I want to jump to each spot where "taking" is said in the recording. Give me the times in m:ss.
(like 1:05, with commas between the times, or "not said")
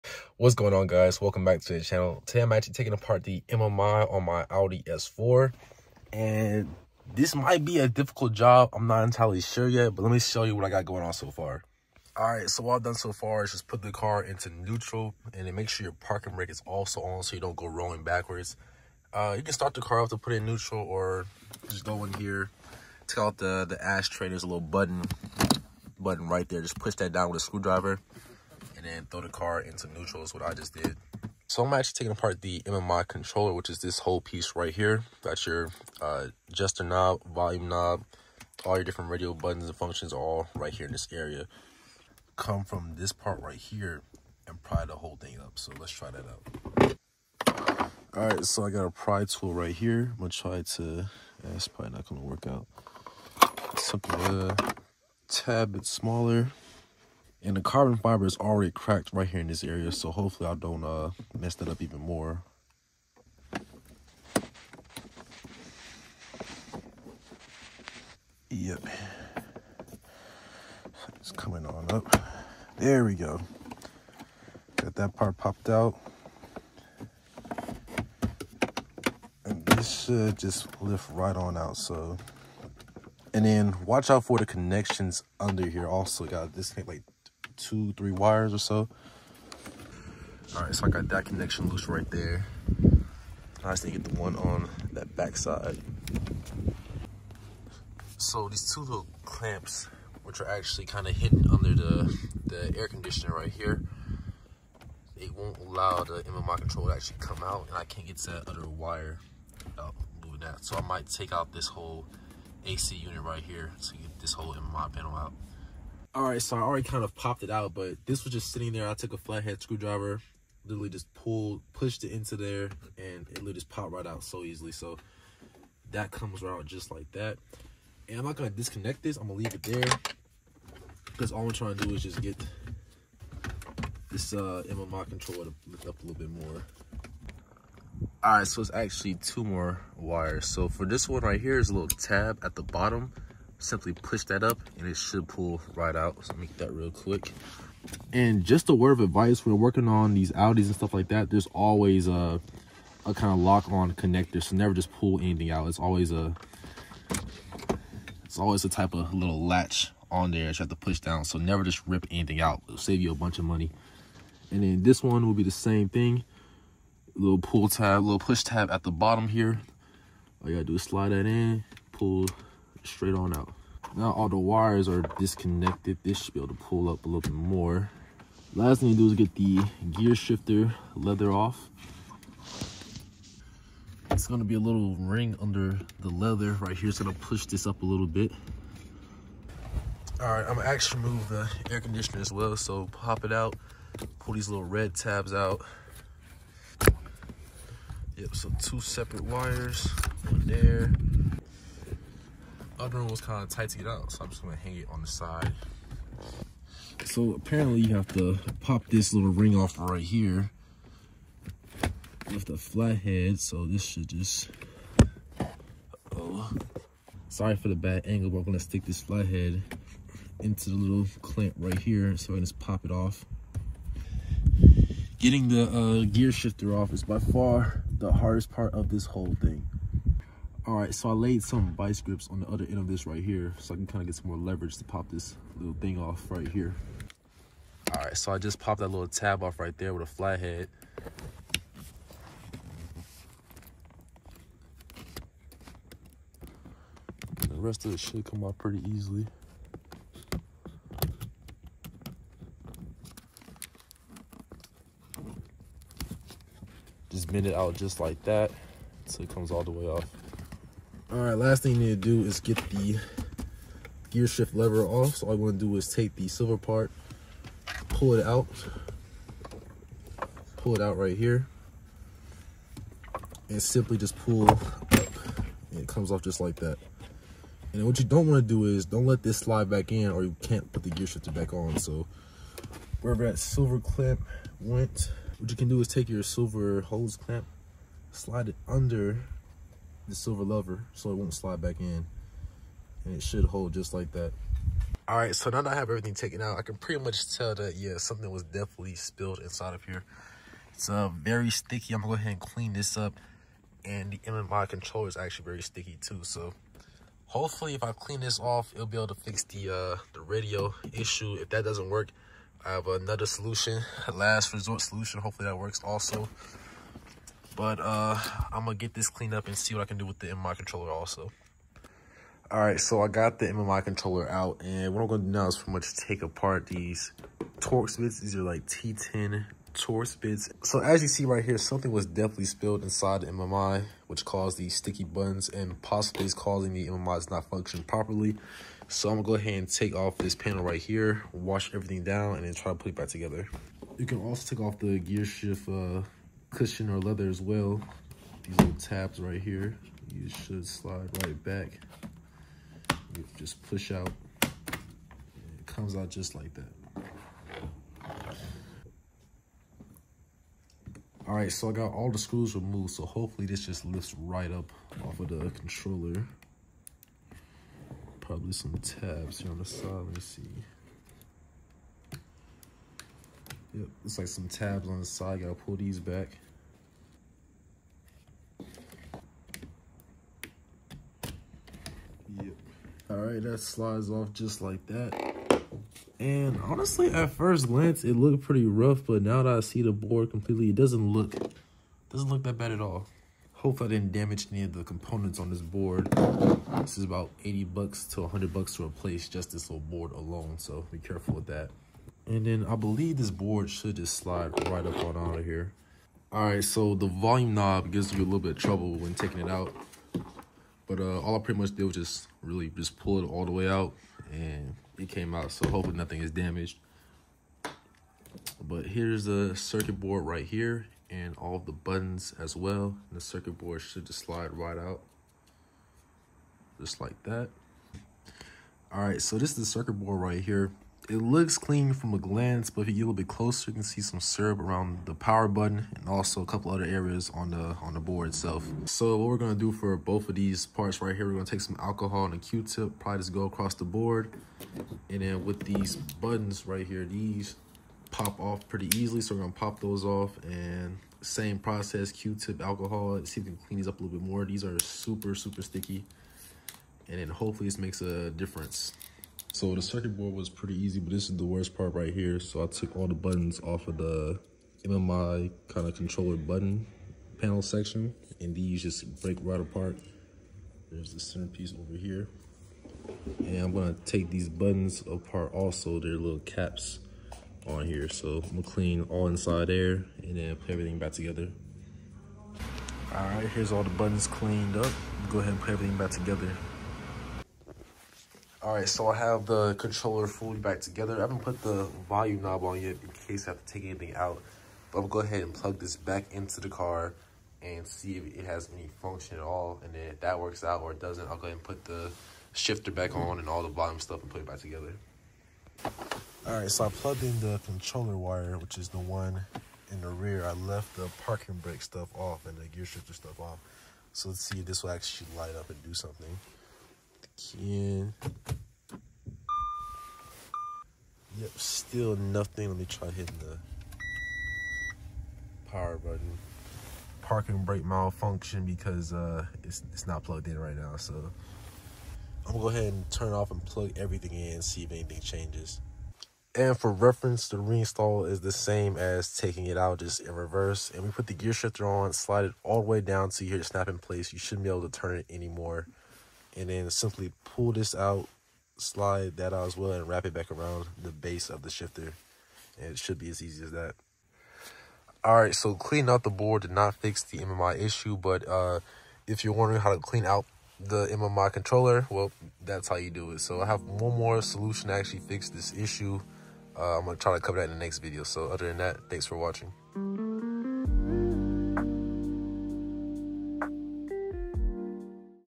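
0:02, 0:31, 6:49, 8:59.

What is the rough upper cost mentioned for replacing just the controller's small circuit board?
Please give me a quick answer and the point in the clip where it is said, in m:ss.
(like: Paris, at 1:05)
100 bucks, at 6:38.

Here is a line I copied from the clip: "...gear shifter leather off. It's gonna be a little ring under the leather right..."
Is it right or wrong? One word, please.
right.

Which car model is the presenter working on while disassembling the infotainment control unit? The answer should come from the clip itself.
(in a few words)
Audi S4.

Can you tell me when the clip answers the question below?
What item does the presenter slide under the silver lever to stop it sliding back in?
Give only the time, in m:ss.
4:46.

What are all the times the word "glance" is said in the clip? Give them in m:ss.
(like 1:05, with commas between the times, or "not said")
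6:27, 7:12.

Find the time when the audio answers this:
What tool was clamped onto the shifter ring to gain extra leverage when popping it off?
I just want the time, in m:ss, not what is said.
3:51.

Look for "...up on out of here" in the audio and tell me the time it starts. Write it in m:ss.
6:44.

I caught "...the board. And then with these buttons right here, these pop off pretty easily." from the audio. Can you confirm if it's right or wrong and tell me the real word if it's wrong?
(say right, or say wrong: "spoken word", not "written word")
right.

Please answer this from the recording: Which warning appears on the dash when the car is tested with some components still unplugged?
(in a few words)
parking brake malfunction.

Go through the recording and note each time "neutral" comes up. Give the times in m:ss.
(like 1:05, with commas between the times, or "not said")
0:14, 0:20, 0:29.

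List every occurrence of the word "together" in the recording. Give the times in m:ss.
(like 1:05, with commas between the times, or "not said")
5:43, 8:01, 8:06, 8:10, 8:24.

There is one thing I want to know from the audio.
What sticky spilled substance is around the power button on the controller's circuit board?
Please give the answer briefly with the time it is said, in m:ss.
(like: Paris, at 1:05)
syrup, at 7:14.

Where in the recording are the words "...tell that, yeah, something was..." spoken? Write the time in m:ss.
4:57.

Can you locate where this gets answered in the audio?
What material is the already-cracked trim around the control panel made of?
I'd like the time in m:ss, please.
0:57.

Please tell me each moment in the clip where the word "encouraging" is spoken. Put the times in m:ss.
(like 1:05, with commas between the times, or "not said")
not said.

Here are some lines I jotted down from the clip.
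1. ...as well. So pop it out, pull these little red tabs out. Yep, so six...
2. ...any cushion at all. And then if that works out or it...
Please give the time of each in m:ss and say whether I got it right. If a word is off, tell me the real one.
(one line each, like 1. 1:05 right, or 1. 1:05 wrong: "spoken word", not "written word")
1. 3:12 wrong: "two", not "six"
2. 8:18 wrong: "function", not "cushion".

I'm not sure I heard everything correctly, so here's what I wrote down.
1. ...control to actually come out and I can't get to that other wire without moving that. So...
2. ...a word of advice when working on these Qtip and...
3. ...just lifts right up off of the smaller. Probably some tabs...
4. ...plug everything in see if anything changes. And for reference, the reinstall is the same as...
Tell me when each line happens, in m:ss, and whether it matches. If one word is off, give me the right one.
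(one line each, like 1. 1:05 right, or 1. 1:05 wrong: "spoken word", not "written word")
1. 1:46 right
2. 2:28 wrong: "Audis", not "Qtip"
3. 6:03 wrong: "controller", not "smaller"
4. 8:53 right.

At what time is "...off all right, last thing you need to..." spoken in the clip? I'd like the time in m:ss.
4:19.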